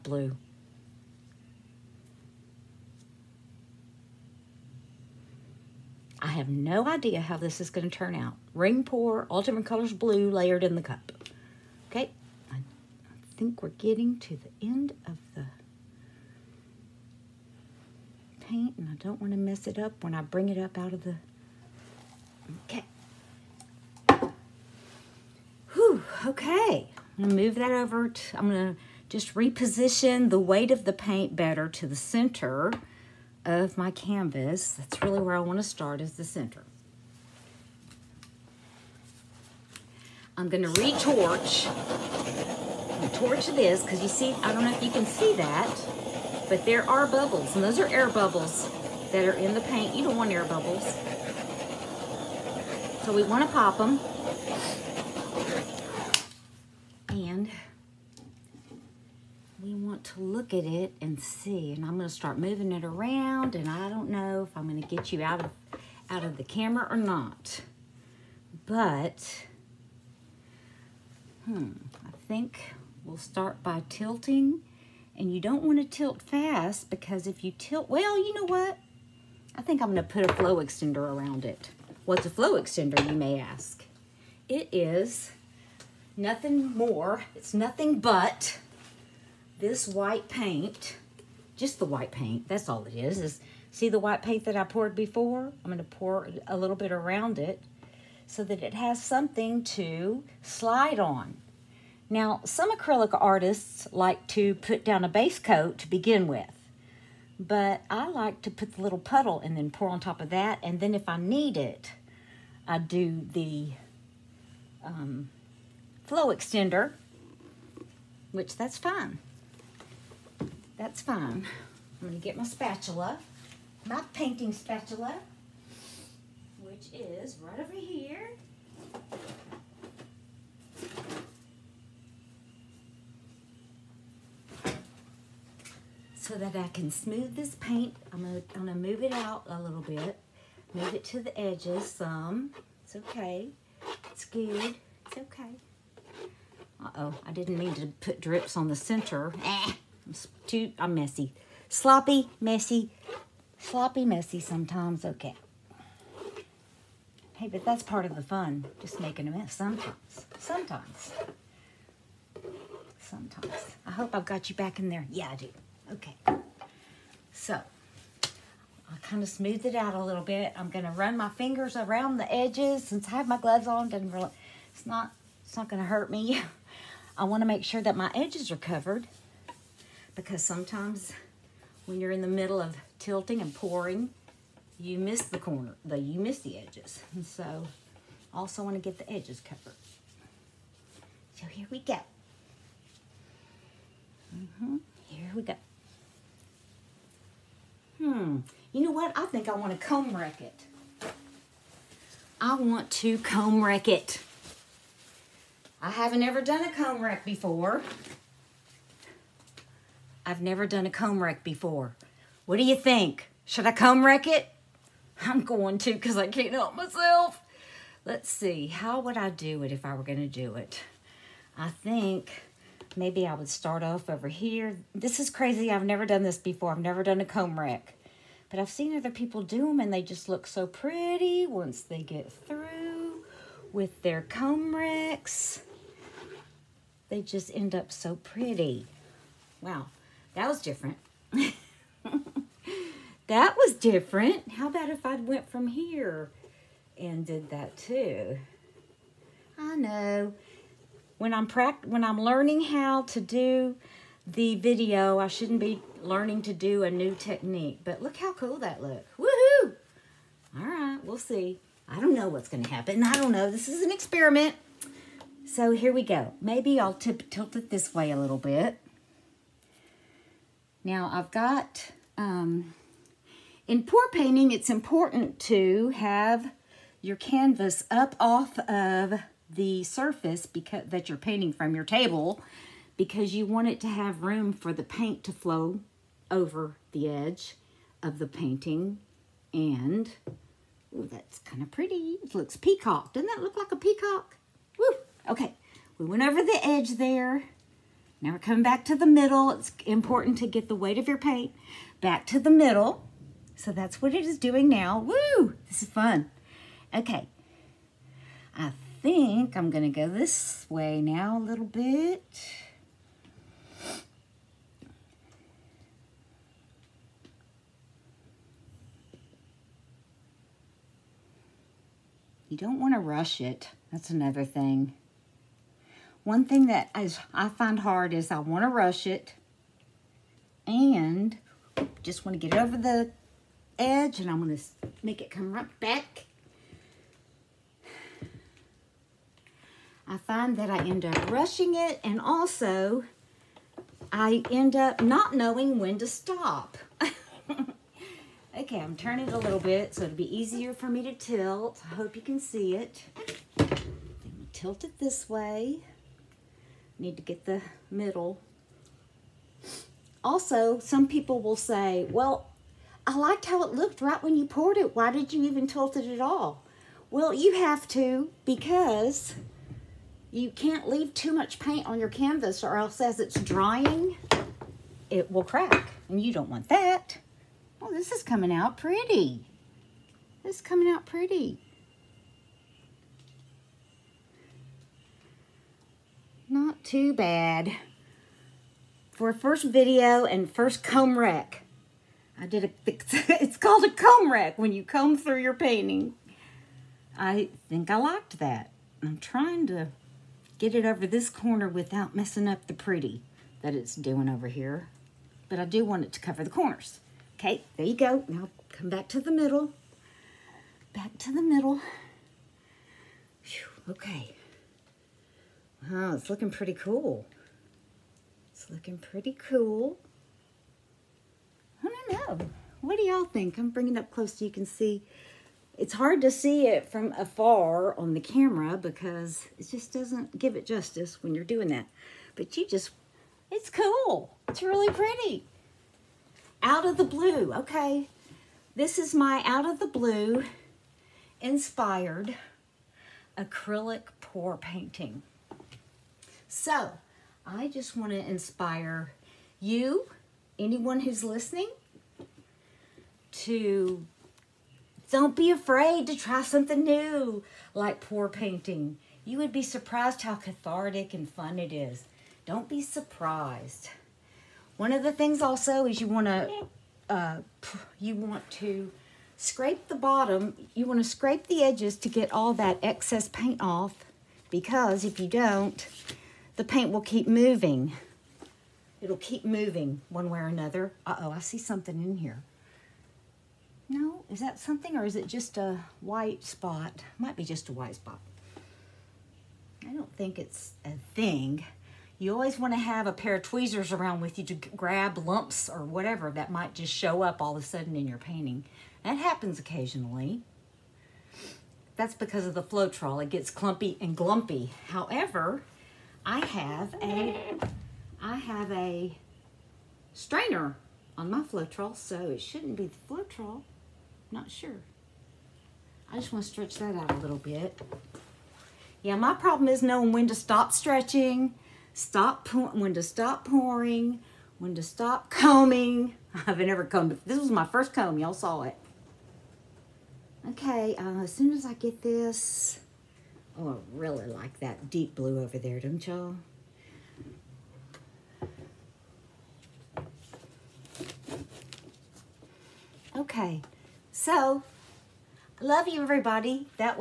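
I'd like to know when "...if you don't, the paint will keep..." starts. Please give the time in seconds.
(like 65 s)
475 s.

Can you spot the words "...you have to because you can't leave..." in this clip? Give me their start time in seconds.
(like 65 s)
367 s.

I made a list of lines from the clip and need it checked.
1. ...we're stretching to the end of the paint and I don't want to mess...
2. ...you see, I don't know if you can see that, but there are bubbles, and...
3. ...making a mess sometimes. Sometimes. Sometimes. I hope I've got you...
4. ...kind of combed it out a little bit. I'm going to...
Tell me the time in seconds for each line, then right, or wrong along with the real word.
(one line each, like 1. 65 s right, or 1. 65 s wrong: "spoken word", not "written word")
1. 13 s wrong: "getting", not "stretching"
2. 44 s right
3. 158 s right
4. 169 s wrong: "smoothed", not "combed".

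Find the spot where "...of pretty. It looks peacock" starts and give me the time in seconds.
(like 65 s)
291 s.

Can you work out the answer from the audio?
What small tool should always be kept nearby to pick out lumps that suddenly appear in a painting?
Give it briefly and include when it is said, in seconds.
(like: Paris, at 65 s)
Tweezers, at 493 s.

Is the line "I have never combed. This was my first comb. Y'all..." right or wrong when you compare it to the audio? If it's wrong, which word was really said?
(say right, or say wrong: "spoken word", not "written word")
right.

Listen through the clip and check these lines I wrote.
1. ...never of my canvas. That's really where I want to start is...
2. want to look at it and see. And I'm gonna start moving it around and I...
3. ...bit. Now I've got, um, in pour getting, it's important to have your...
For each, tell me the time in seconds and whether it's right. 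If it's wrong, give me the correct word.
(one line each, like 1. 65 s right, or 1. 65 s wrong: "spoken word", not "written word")
1. 31 s wrong: "center", not "never"
2. 59 s right
3. 268 s wrong: "painting", not "getting".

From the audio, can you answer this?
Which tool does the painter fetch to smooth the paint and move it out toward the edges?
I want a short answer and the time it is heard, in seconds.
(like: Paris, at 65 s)
Painting spatula, at 124 s.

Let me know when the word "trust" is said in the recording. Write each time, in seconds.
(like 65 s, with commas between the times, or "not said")
not said.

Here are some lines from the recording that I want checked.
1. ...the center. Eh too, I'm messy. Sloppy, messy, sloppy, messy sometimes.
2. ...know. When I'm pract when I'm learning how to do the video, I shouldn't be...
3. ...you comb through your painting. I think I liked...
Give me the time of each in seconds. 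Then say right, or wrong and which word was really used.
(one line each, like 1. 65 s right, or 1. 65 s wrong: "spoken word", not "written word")
1. 148 s right
2. 249 s right
3. 394 s right.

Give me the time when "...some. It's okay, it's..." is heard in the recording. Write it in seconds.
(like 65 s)
141 s.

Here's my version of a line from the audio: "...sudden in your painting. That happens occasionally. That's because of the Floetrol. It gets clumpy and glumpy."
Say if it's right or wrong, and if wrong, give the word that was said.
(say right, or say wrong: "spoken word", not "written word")
right.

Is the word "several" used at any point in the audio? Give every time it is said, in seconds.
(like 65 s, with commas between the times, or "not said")
not said.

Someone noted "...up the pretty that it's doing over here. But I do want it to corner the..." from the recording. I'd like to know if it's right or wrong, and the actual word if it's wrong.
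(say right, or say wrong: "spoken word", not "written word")
wrong: "cover", not "corner".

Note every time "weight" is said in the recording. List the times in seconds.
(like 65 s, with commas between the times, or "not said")
30 s, 300 s.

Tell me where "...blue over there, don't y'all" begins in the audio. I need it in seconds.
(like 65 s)
535 s.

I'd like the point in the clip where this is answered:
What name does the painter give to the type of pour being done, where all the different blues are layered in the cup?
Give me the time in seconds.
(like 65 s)
8 s.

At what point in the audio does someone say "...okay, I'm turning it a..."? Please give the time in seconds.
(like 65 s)
348 s.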